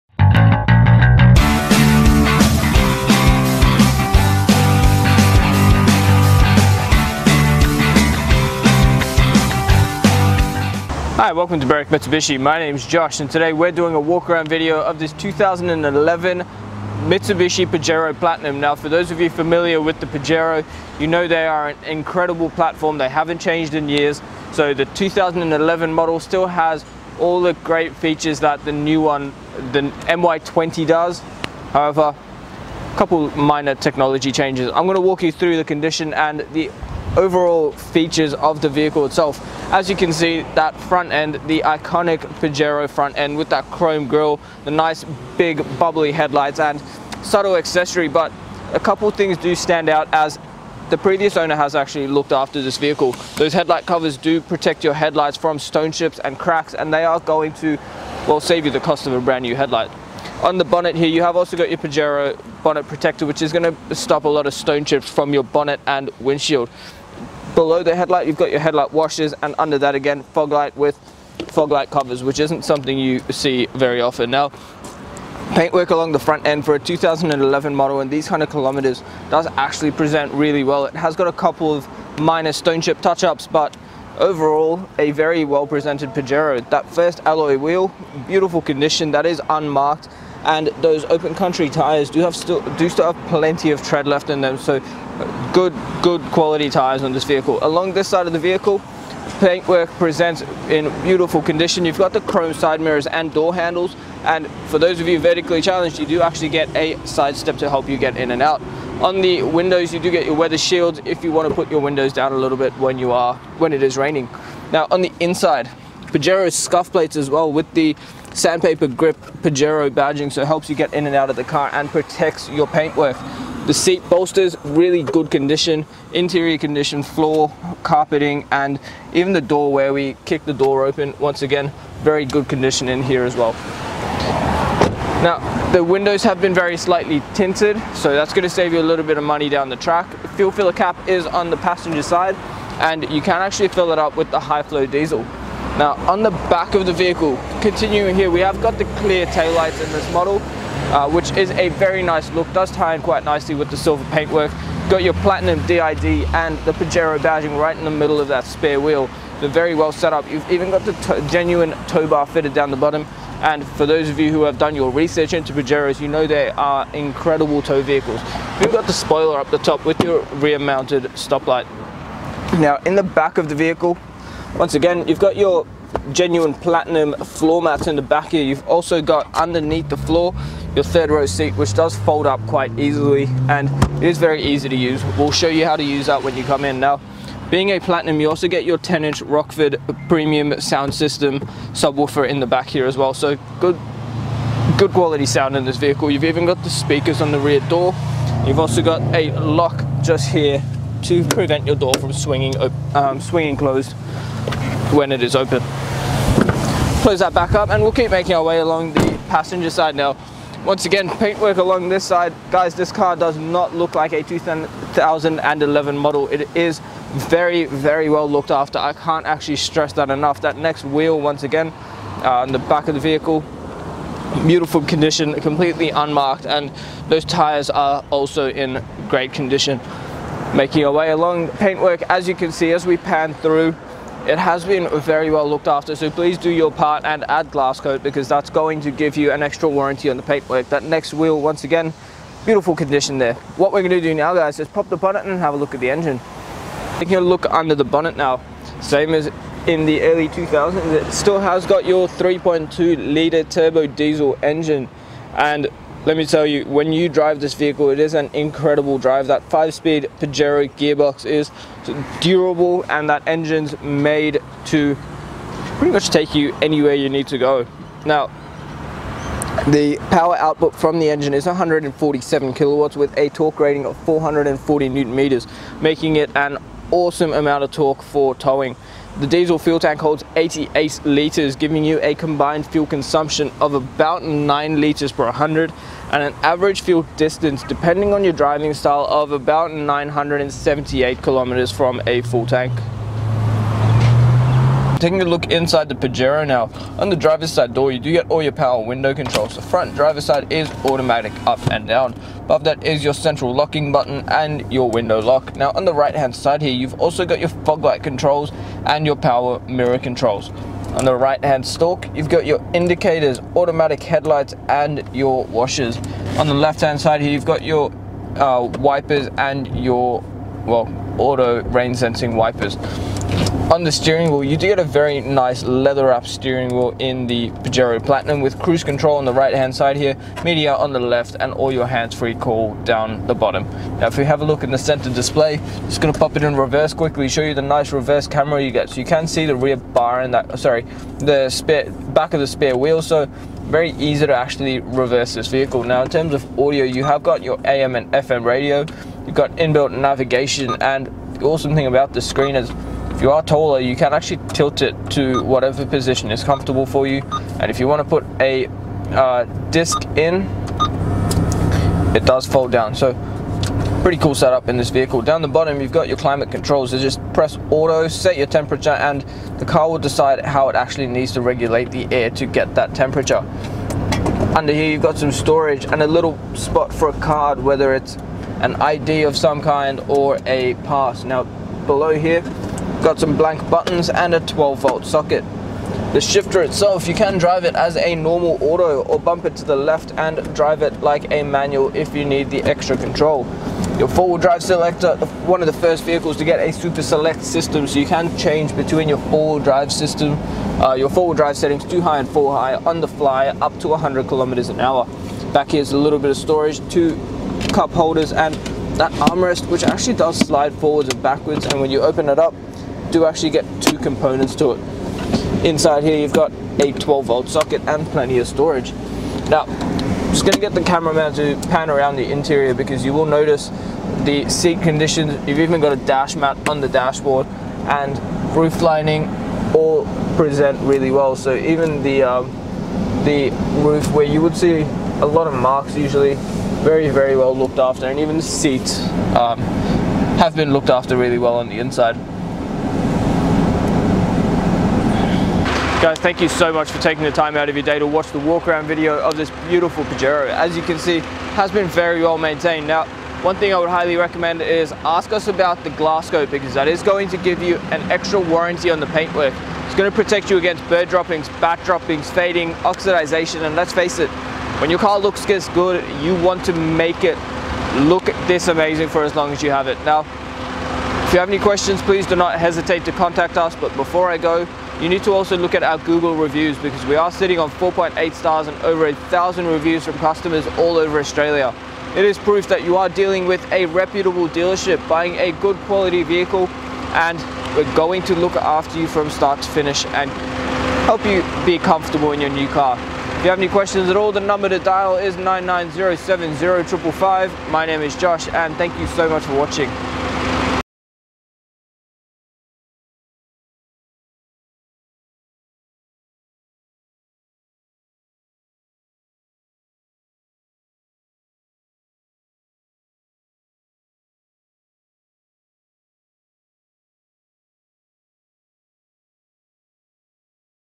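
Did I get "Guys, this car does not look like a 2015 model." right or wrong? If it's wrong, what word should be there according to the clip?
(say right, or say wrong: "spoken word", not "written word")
wrong: "2011", not "2015".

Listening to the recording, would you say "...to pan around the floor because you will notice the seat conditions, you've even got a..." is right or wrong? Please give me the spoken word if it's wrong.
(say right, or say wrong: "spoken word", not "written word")
wrong: "interior", not "floor".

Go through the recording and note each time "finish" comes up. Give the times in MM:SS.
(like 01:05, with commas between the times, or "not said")
08:09.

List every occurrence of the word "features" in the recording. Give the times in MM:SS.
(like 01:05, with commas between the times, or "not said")
00:27, 00:37.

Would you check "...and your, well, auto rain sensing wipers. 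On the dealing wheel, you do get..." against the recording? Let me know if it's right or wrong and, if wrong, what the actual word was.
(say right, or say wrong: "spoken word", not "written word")
wrong: "steering", not "dealing".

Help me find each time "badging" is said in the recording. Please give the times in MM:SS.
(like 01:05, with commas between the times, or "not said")
01:59, 02:37.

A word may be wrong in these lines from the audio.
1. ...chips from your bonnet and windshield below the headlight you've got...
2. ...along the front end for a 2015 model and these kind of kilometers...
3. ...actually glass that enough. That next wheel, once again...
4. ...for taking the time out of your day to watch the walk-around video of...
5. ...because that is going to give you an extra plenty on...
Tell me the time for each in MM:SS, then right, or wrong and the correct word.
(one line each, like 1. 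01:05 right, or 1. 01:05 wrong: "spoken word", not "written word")
1. 01:04 right
2. 01:15 wrong: "2011", not "2015"
3. 03:39 wrong: "stress", not "glass"
4. 07:26 right
5. 07:36 wrong: "warranty", not "plenty".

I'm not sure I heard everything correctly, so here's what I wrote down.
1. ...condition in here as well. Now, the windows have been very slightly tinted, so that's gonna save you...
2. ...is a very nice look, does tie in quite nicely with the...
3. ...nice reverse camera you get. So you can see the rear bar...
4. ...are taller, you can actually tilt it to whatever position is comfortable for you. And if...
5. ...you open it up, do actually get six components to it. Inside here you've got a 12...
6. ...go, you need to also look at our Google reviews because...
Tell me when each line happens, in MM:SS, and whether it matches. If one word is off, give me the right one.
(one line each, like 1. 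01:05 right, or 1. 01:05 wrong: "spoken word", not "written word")
1. 02:12 right
2. 02:31 right
3. 05:37 right
4. 05:53 right
5. 06:51 wrong: "two", not "six"
6. 07:54 right.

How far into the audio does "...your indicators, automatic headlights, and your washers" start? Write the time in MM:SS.
05:12.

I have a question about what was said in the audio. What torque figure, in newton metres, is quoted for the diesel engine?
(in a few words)
440.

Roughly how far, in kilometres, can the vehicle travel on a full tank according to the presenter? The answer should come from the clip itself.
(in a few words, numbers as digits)
978 km.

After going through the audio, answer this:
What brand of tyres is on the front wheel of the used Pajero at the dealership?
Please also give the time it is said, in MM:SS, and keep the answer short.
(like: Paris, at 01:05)
Open Country, at 01:31.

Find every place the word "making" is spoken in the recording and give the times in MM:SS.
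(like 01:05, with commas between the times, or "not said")
03:28, 03:50, 04:35.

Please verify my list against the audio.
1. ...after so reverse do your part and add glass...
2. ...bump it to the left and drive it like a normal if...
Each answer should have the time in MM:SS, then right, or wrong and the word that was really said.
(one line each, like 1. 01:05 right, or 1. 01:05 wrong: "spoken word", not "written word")
1. 03:55 wrong: "please", not "reverse"
2. 06:29 wrong: "manual", not "normal".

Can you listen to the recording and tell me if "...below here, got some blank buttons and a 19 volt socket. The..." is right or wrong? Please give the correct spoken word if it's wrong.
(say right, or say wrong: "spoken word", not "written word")
wrong: "12", not "19".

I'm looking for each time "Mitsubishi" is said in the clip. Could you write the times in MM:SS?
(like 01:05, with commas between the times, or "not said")
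00:11, 00:17.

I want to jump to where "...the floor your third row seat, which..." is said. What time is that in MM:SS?
02:59.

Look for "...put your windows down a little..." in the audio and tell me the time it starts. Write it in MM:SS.
01:51.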